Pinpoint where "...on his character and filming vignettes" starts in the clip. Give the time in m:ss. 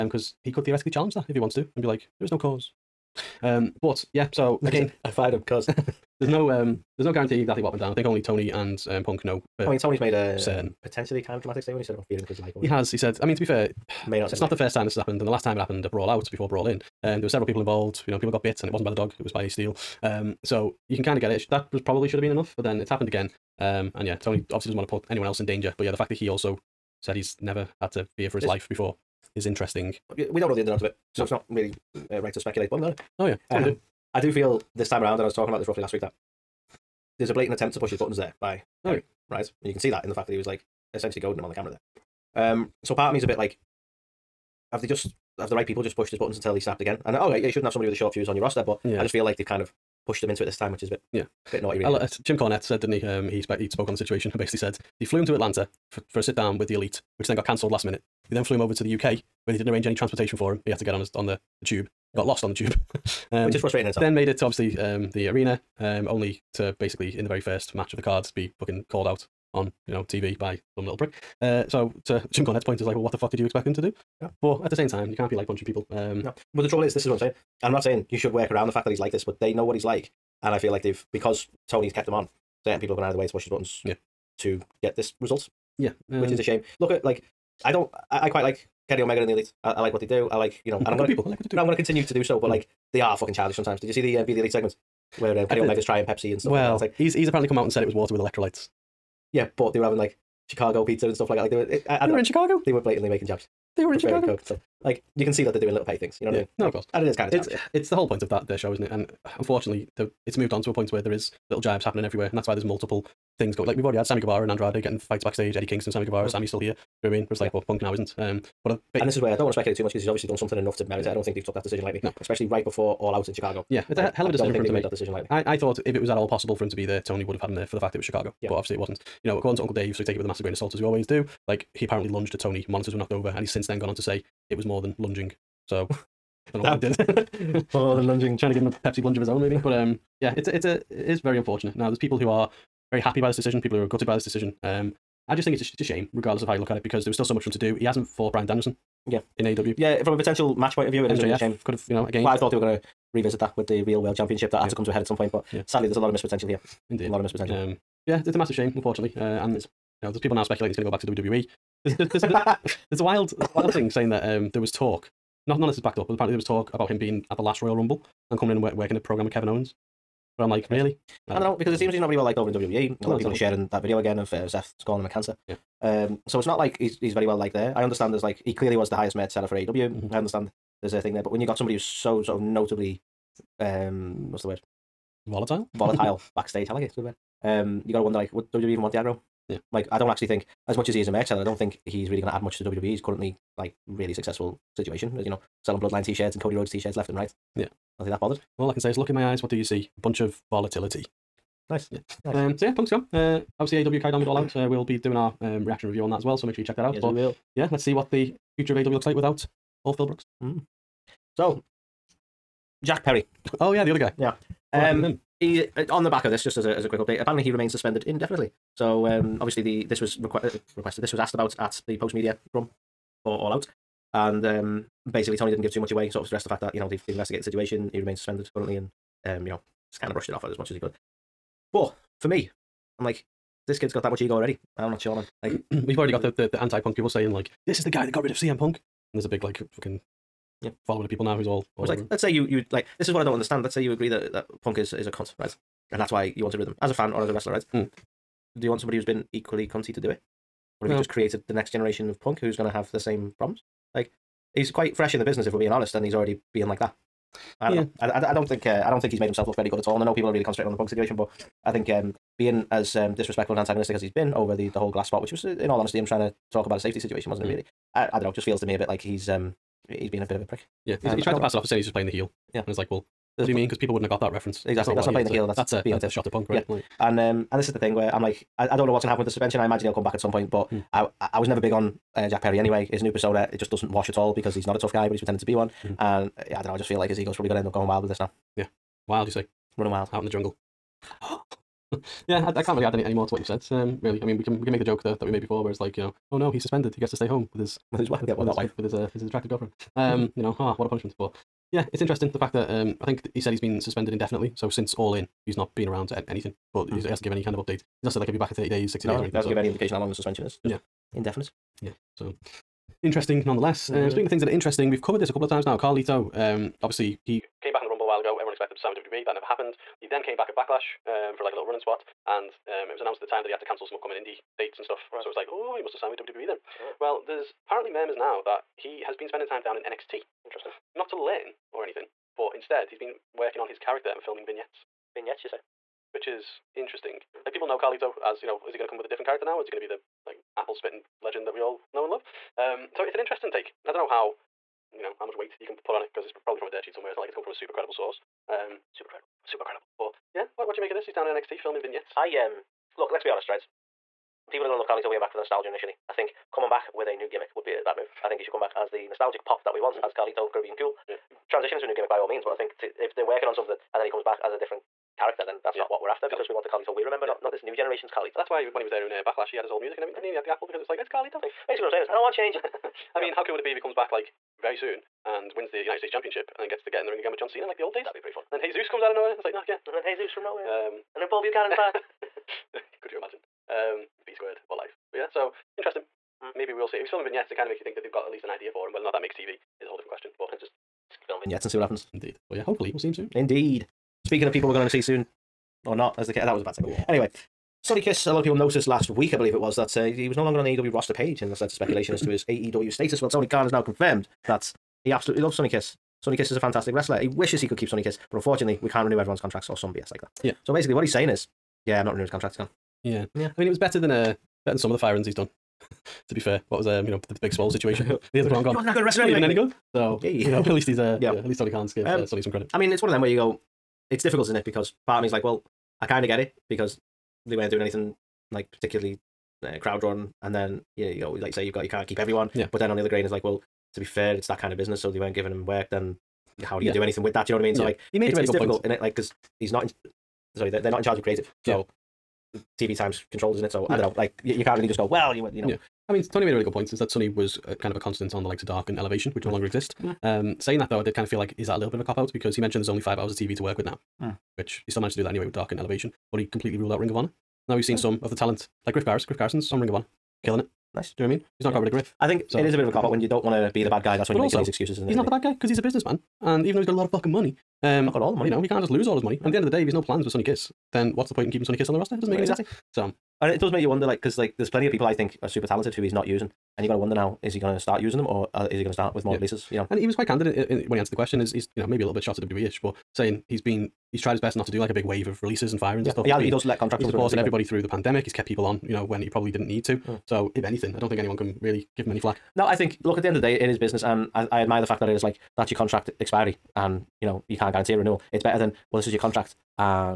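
5:33.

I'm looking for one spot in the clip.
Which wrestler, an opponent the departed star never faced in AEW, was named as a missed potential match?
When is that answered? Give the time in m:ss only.
2:28.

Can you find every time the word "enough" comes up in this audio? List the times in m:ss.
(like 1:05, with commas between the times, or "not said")
0:22, 2:00.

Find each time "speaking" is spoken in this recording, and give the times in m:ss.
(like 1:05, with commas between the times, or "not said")
5:14, 6:34.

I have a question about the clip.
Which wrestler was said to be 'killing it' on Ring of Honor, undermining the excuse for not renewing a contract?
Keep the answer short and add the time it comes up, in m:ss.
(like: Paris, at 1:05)
Griff Garrison, at 7:39.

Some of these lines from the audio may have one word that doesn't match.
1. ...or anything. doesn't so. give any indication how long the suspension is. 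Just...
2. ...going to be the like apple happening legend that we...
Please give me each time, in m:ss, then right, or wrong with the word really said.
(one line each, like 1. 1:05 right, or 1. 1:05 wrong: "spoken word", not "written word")
1. 5:09 right
2. 5:39 wrong: "spitting", not "happening".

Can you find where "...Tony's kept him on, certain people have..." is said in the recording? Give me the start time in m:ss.
1:21.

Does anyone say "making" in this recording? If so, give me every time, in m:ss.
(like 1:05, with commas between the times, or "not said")
1:43, 7:44.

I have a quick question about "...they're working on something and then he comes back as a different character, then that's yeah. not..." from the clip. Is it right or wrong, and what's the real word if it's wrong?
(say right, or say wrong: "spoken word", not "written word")
right.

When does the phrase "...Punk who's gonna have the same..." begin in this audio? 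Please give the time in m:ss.
4:12.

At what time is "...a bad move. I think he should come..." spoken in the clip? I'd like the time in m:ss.
5:57.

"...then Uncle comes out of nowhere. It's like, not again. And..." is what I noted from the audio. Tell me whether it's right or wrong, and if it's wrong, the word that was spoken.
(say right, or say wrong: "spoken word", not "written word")
wrong: "Jesus", not "Uncle".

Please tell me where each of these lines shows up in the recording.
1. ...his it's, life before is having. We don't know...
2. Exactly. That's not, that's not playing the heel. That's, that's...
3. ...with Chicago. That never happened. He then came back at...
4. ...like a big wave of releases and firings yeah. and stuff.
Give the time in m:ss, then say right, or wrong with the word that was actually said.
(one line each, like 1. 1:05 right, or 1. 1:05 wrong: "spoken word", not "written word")
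1. 0:28 wrong: "interesting", not "having"
2. 4:34 right
3. 5:18 wrong: "WWE", not "Chicago"
4. 8:04 right.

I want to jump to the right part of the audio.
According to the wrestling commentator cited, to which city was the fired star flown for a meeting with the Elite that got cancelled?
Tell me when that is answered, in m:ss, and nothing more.
0:55.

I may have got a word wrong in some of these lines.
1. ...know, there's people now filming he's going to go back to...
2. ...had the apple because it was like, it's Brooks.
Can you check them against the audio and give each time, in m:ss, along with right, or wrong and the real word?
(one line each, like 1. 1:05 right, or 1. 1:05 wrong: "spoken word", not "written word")
1. 2:40 wrong: "speculating", not "filming"
2. 6:10 wrong: "Carlito", not "Brooks".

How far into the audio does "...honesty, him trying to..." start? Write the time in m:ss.
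4:25.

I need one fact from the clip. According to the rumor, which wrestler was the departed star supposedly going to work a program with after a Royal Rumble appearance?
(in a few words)
Kevin Owens.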